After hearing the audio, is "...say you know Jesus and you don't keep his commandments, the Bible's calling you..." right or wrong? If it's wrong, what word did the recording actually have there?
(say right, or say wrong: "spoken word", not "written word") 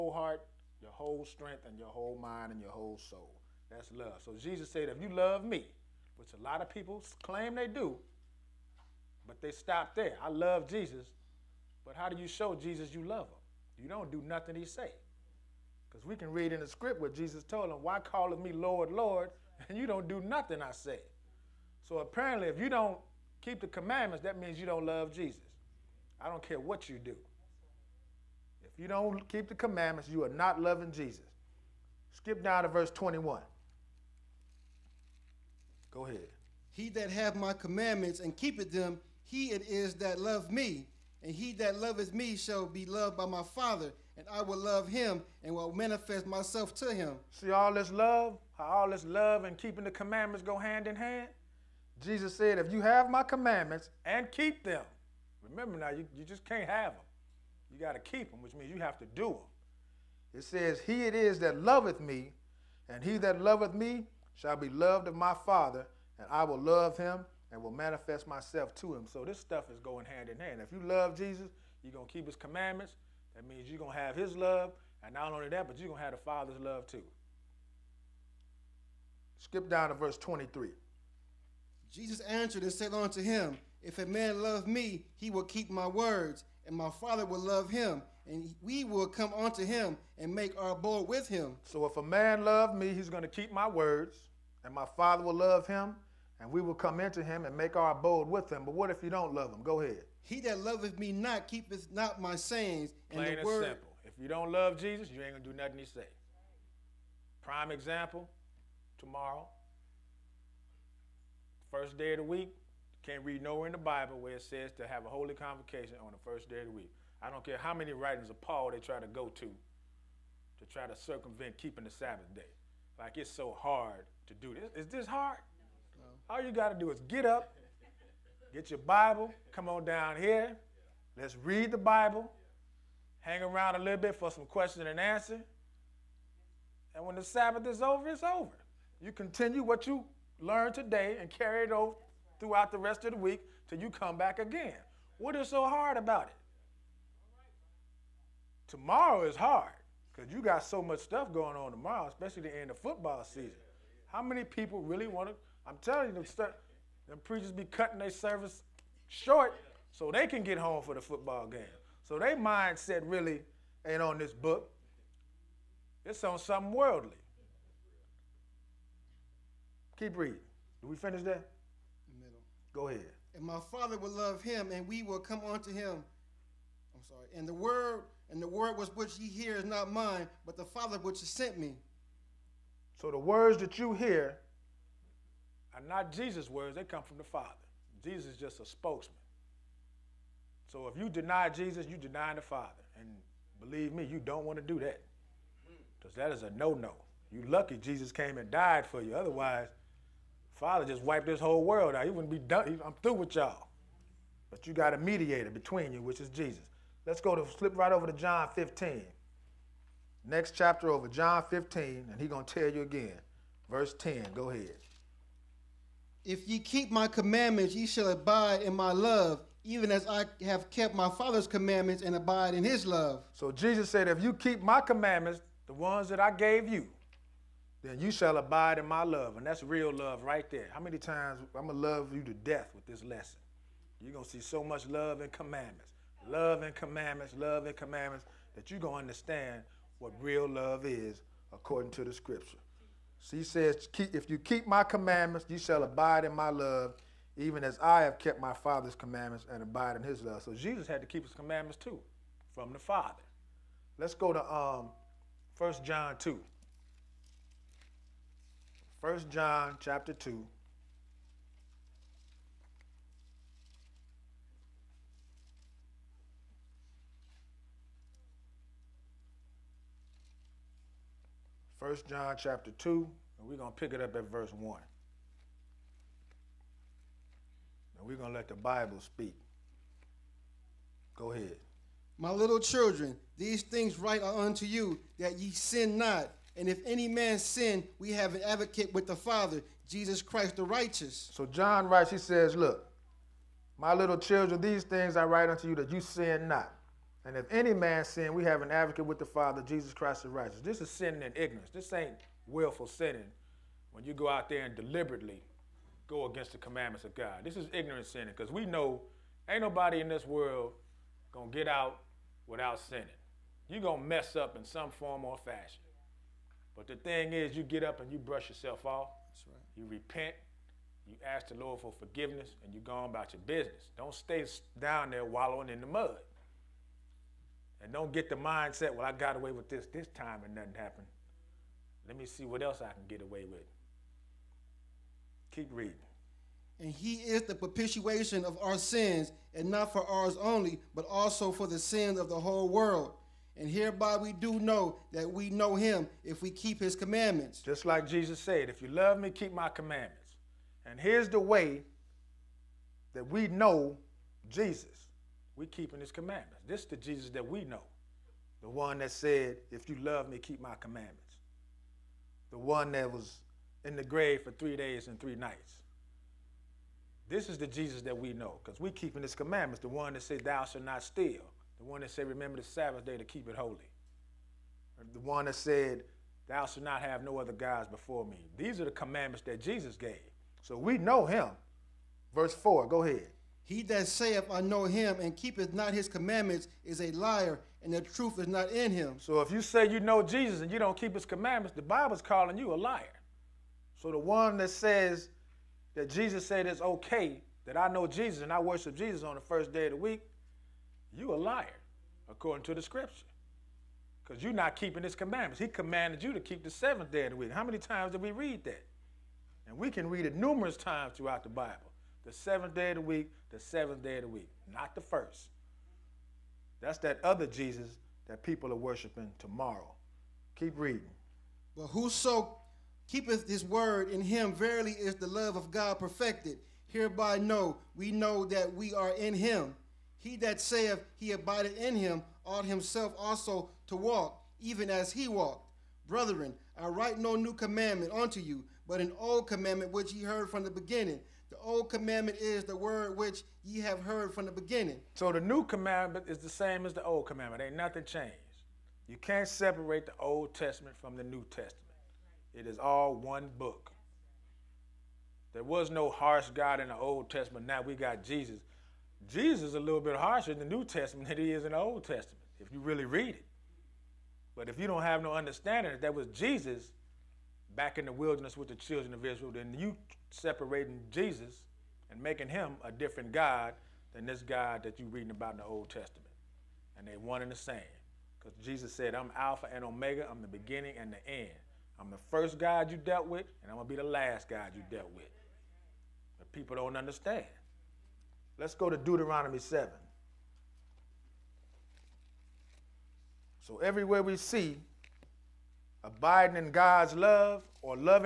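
right.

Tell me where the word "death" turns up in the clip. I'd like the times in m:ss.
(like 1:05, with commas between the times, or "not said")
3:52.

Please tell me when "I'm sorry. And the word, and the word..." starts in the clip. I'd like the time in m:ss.
2:56.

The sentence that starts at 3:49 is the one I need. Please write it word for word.
And that's real love right there.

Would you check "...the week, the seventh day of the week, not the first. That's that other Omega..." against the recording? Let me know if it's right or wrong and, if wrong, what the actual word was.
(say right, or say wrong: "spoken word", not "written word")
wrong: "Jesus", not "Omega".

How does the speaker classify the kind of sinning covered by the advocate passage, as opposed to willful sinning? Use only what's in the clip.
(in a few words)
Sinning in ignorance.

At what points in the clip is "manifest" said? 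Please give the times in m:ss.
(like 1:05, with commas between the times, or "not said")
0:45, 1:07.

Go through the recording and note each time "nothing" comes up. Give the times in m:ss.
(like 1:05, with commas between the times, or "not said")
0:14, 0:20, 1:45, 5:30, 7:27.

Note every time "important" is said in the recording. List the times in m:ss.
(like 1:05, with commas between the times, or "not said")
not said.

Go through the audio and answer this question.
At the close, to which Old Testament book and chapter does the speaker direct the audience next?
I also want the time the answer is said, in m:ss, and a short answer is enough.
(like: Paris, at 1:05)
Deuteronomy 7, at 8:08.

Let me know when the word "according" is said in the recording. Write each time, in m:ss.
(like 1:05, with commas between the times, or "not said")
4:01, 6:42.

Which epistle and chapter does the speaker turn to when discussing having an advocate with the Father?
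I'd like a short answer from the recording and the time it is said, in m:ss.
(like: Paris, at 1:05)
1 John 2, at 4:15.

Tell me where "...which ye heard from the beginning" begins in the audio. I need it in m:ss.
7:19.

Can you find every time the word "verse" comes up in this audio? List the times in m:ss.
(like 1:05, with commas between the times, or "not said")
0:32, 1:19, 3:33, 4:34, 6:22.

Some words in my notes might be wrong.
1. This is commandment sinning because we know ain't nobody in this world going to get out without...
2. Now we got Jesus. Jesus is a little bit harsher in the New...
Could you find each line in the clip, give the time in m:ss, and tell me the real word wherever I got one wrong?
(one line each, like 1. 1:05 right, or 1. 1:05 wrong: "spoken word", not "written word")
1. 5:07 wrong: "ignorant", not "commandment"
2. 7:37 right.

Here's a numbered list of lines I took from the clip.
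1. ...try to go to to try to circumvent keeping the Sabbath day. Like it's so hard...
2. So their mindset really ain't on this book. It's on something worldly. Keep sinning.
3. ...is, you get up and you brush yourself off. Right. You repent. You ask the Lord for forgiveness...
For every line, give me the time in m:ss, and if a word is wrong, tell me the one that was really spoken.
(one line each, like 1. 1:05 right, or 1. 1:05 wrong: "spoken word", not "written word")
1. 1:58 right
2. 2:42 wrong: "reading", not "sinning"
3. 5:17 right.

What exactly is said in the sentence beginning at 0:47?
See all this love, how all this love and keeping the commandments go hand in hand?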